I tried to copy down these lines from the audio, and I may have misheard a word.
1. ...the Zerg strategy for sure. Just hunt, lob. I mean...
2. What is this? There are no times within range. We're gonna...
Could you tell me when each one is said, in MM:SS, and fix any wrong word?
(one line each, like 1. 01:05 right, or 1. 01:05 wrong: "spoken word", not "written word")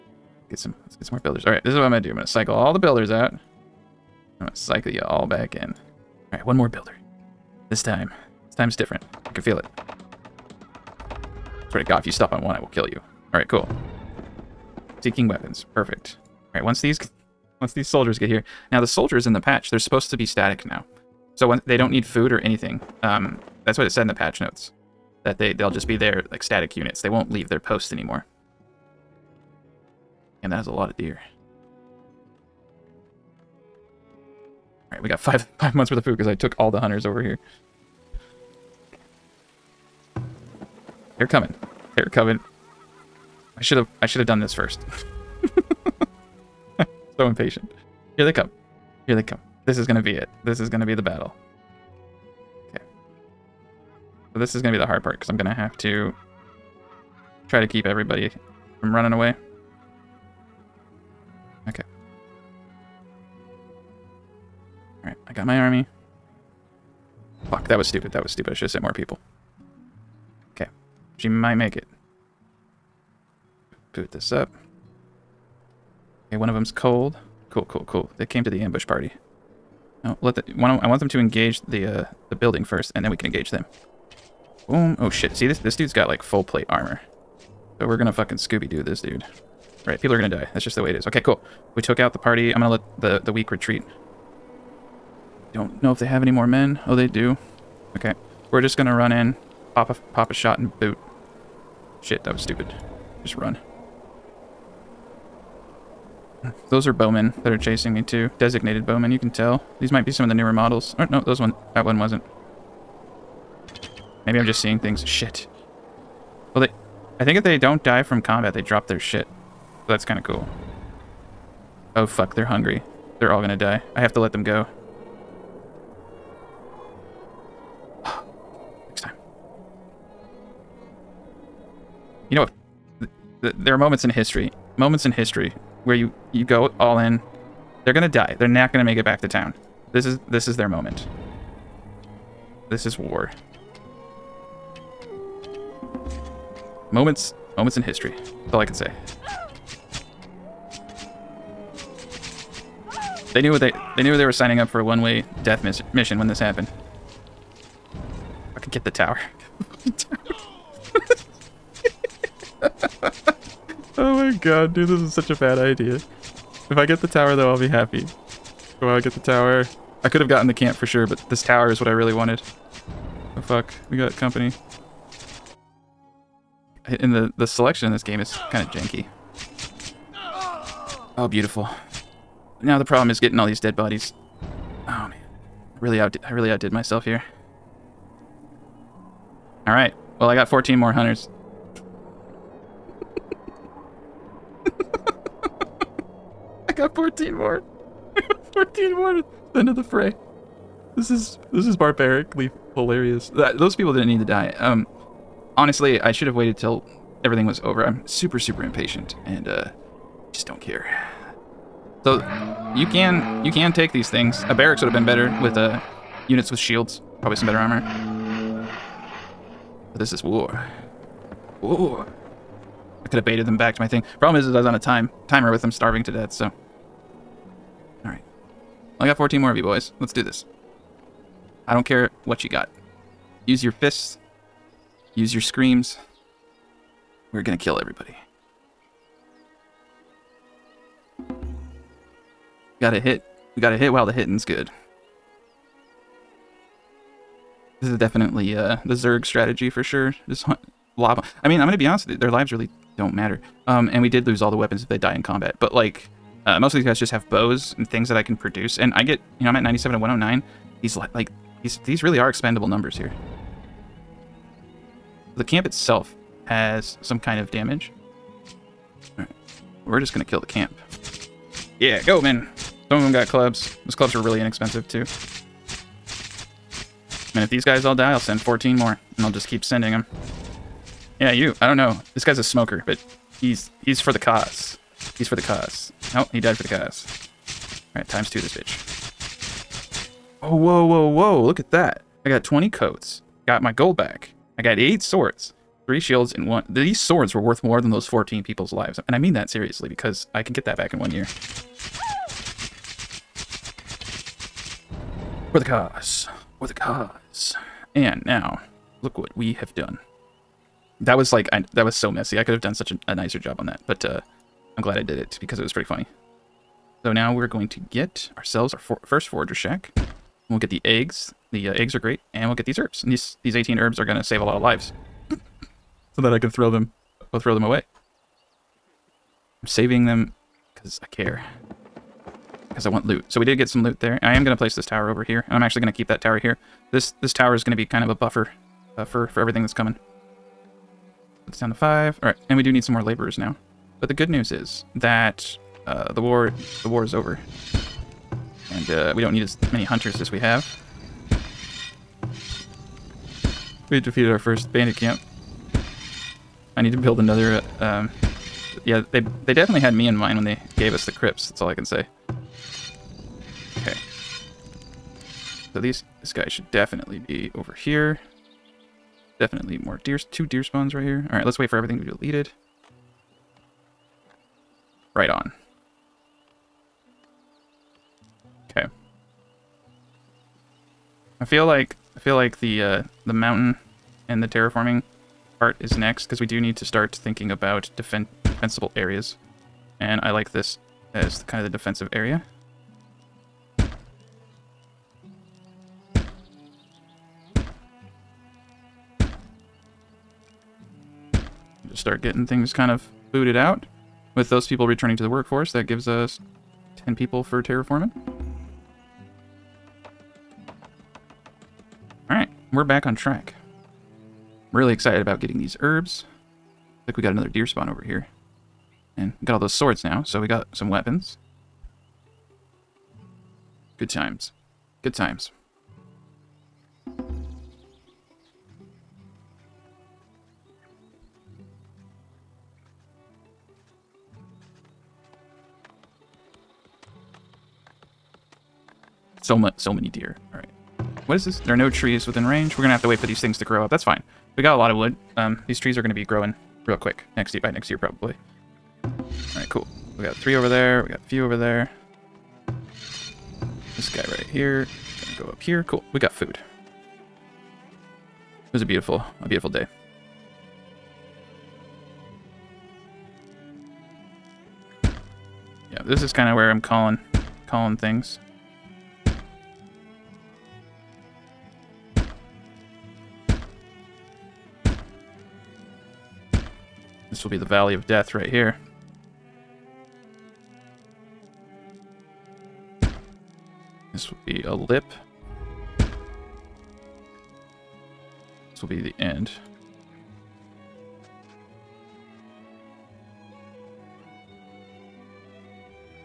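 1. 04:08 right
2. 07:21 wrong: "trees", not "times".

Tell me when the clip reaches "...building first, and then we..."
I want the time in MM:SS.
01:22.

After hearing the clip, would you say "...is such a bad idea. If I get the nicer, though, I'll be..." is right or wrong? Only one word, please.
wrong.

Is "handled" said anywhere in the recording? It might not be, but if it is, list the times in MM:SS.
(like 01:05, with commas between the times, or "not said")
not said.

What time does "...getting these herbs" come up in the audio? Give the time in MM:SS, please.
06:55.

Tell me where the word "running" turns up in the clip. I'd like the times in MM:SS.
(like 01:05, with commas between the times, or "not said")
00:58.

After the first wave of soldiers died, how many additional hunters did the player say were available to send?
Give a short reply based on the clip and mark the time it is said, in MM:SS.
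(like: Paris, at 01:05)
14, at 03:10.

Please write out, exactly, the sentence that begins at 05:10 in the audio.
That was like, I, that was so messy.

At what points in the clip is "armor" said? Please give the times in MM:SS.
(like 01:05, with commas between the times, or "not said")
01:26, 03:37.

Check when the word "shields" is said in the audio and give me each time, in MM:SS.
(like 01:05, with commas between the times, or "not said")
03:36, 04:56.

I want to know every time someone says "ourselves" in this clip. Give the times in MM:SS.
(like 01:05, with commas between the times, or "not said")
05:18.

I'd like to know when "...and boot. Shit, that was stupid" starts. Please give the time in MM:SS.
01:40.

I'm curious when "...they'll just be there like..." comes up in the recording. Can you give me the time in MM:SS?
00:25.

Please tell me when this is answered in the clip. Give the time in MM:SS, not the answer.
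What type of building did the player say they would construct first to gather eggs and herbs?
05:19.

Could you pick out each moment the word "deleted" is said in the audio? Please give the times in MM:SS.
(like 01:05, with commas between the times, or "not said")
06:12.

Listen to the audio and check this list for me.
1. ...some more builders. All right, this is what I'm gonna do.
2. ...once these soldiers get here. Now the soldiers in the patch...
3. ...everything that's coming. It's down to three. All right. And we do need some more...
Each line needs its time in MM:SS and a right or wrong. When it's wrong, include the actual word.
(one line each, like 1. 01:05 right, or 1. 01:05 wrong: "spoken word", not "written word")
1. 00:01 right
2. 00:17 right
3. 05:39 wrong: "five", not "three".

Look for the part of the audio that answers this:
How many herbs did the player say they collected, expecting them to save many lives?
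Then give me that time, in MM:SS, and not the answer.
05:23.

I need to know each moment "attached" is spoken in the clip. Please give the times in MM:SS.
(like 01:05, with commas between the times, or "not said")
not said.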